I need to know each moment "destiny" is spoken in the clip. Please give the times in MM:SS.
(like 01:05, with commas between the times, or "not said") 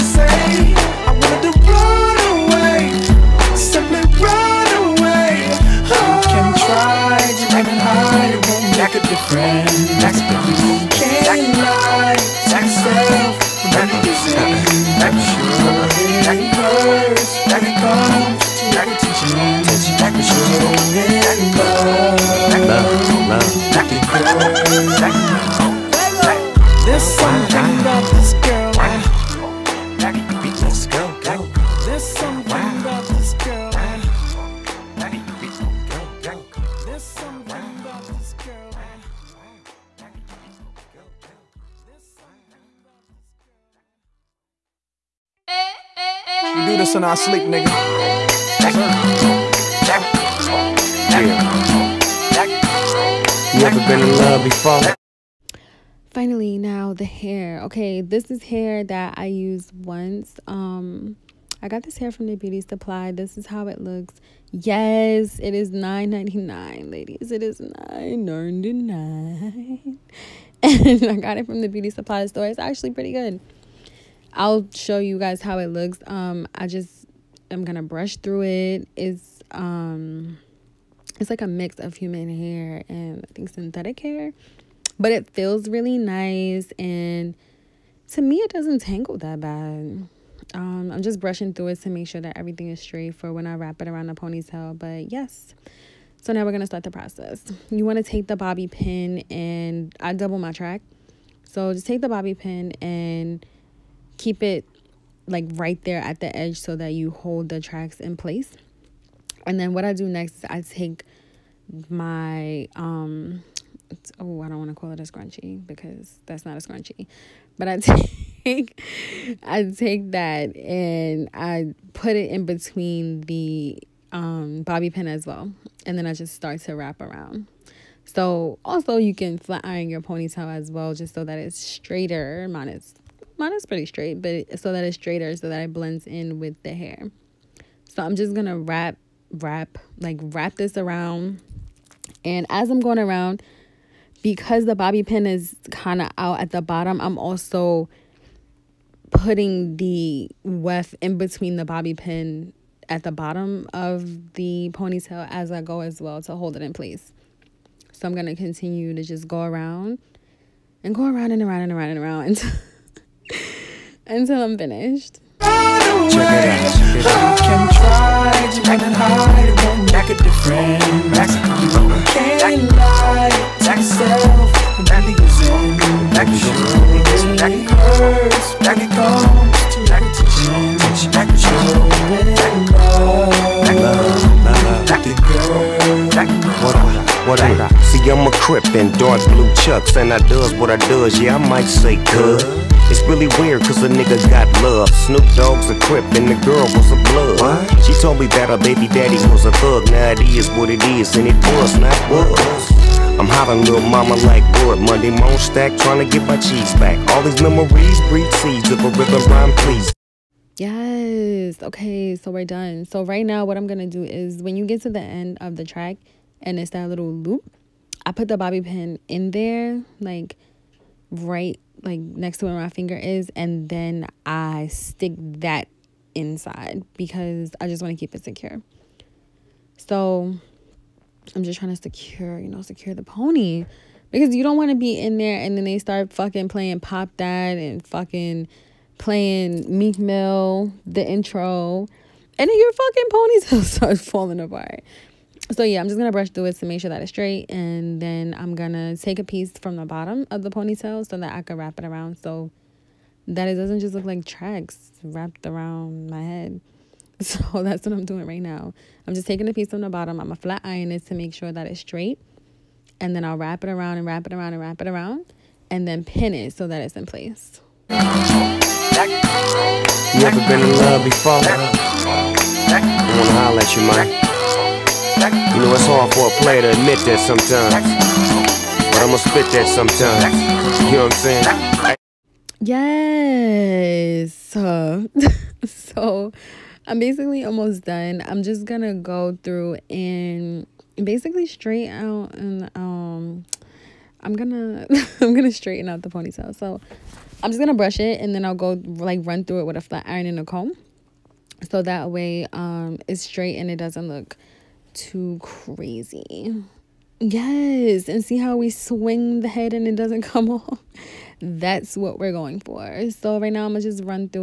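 not said.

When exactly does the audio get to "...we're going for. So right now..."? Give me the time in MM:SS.
05:12.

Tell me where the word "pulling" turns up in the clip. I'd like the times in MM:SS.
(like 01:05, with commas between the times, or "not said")
not said.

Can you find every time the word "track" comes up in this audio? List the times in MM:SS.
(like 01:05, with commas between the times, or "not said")
01:40, 01:47, 03:35, 04:14.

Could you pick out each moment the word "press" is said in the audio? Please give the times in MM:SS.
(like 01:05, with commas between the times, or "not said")
not said.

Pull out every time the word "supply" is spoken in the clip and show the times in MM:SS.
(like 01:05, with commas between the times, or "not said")
01:02, 01:11.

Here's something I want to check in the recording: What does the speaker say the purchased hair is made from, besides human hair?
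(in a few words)
synthetic hair.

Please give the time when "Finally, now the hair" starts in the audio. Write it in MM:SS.
00:56.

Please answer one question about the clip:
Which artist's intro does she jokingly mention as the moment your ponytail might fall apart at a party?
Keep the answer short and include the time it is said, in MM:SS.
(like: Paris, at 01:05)
Meek Mill, at 03:59.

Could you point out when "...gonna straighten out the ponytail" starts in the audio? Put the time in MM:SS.
04:55.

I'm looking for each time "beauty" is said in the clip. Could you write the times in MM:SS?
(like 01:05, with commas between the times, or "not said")
01:02, 01:11.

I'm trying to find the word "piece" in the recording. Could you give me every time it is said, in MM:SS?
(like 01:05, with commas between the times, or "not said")
04:09, 04:19.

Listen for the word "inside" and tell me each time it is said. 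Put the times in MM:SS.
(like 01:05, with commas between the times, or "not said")
03:46.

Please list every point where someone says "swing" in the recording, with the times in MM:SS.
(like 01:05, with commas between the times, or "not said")
05:08.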